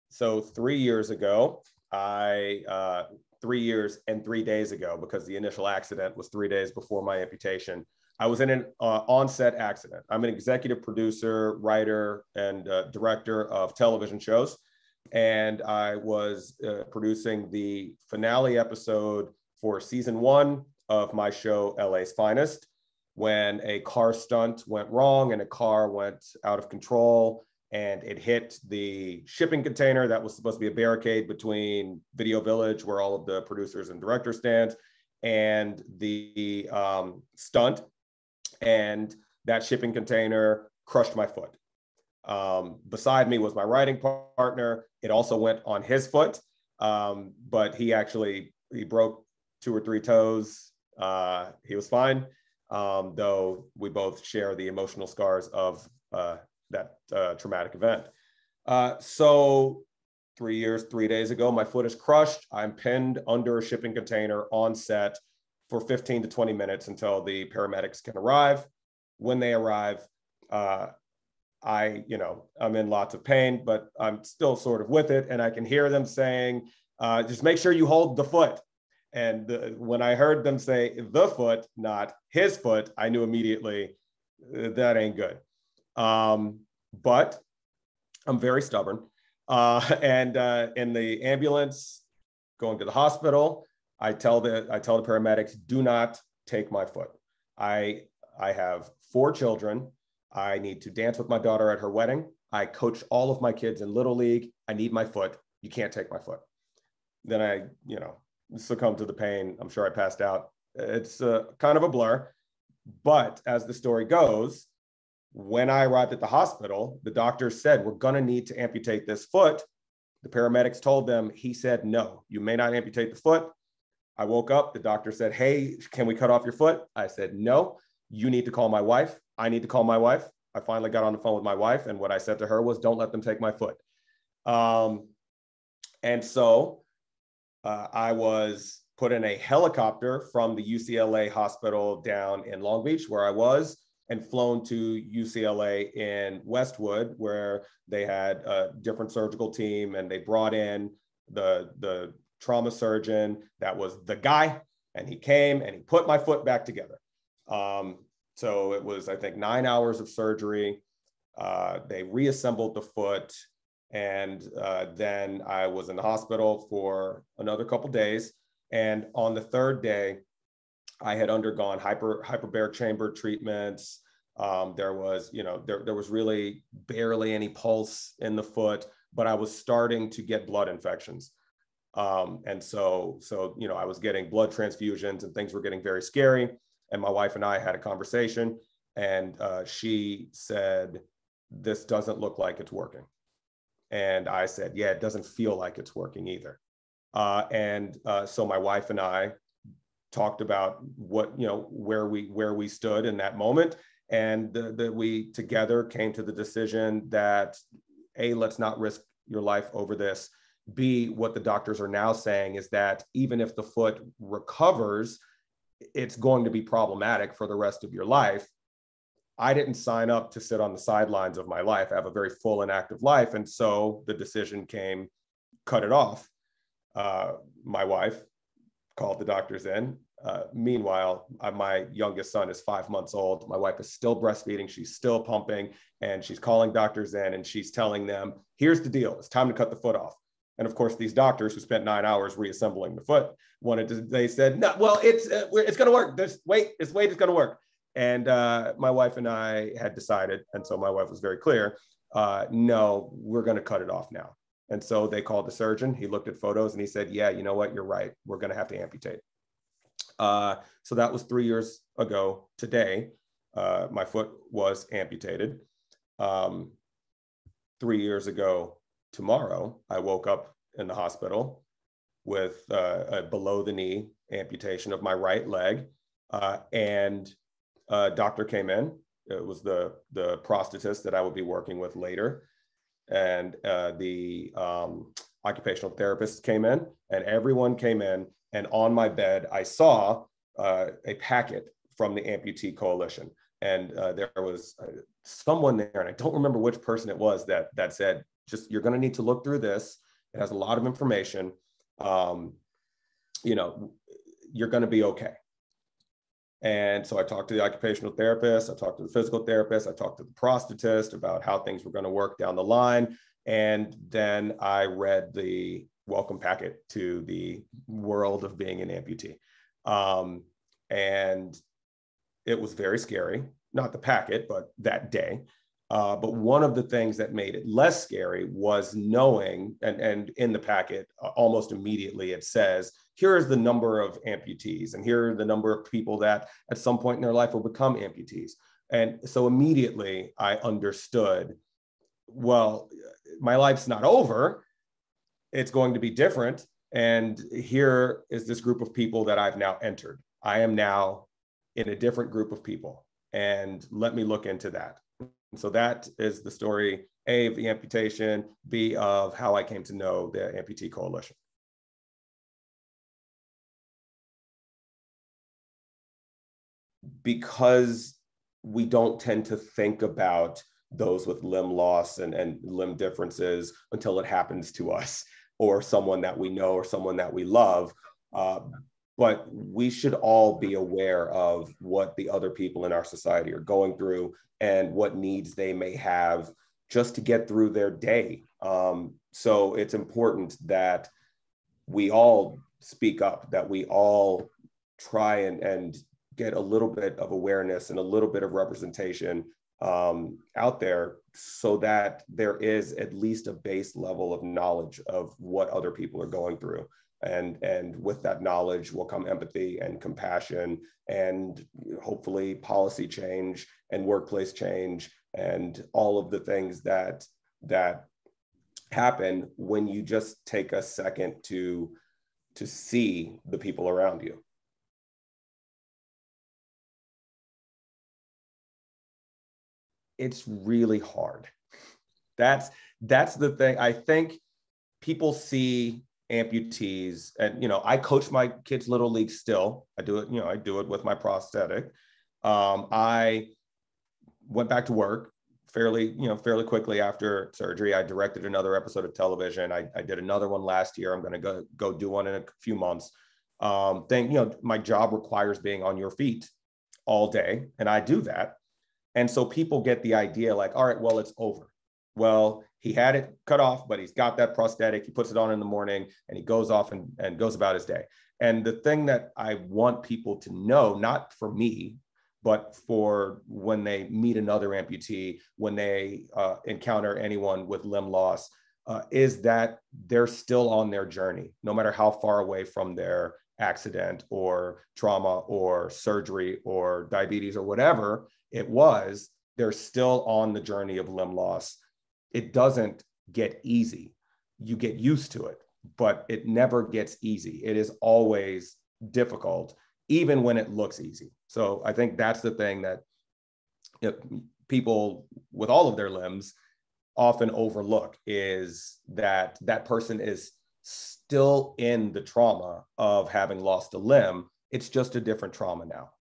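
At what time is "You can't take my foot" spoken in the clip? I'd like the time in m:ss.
1:45.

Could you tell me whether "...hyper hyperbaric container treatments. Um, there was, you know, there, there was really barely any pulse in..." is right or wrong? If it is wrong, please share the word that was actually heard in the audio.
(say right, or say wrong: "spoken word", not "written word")
wrong: "chamber", not "container".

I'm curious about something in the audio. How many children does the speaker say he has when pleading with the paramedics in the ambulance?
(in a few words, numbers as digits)
4.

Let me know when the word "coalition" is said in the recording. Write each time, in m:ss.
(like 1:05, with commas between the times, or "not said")
4:52, 6:00.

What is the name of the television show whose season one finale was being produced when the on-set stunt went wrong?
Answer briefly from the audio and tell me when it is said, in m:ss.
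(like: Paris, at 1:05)
LA's Finest, at 0:21.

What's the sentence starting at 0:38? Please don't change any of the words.
And that shipping container crushed my foot.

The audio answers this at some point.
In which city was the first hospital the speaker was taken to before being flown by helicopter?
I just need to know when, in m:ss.
2:22.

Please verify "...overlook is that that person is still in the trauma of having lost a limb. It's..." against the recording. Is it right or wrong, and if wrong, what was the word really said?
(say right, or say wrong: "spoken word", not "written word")
right.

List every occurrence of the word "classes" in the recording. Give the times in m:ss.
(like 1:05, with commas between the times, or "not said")
not said.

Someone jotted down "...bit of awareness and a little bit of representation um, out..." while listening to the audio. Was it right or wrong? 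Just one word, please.
right.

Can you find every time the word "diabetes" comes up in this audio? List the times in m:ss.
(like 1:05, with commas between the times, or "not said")
8:07.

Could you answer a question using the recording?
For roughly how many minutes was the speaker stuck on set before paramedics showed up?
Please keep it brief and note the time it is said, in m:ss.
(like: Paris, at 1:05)
15 to 20 minutes, at 1:05.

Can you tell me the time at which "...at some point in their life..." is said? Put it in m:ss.
5:36.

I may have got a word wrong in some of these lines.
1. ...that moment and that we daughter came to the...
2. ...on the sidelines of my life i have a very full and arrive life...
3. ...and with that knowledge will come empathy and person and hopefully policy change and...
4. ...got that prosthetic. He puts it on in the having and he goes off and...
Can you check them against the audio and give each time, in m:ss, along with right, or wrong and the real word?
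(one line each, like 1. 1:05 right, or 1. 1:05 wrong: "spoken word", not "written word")
1. 3:23 wrong: "together", not "daughter"
2. 3:40 wrong: "active", not "arrive"
3. 6:47 wrong: "compassion", not "person"
4. 7:44 wrong: "morning", not "having".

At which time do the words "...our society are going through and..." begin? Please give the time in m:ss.
6:22.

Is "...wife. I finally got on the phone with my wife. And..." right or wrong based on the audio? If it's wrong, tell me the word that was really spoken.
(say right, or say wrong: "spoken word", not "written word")
right.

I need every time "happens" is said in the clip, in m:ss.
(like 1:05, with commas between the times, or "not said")
6:14, 6:58.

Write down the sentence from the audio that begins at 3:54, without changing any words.
She's still pumping and she's calling doctors in and she's telling them, here's the deal.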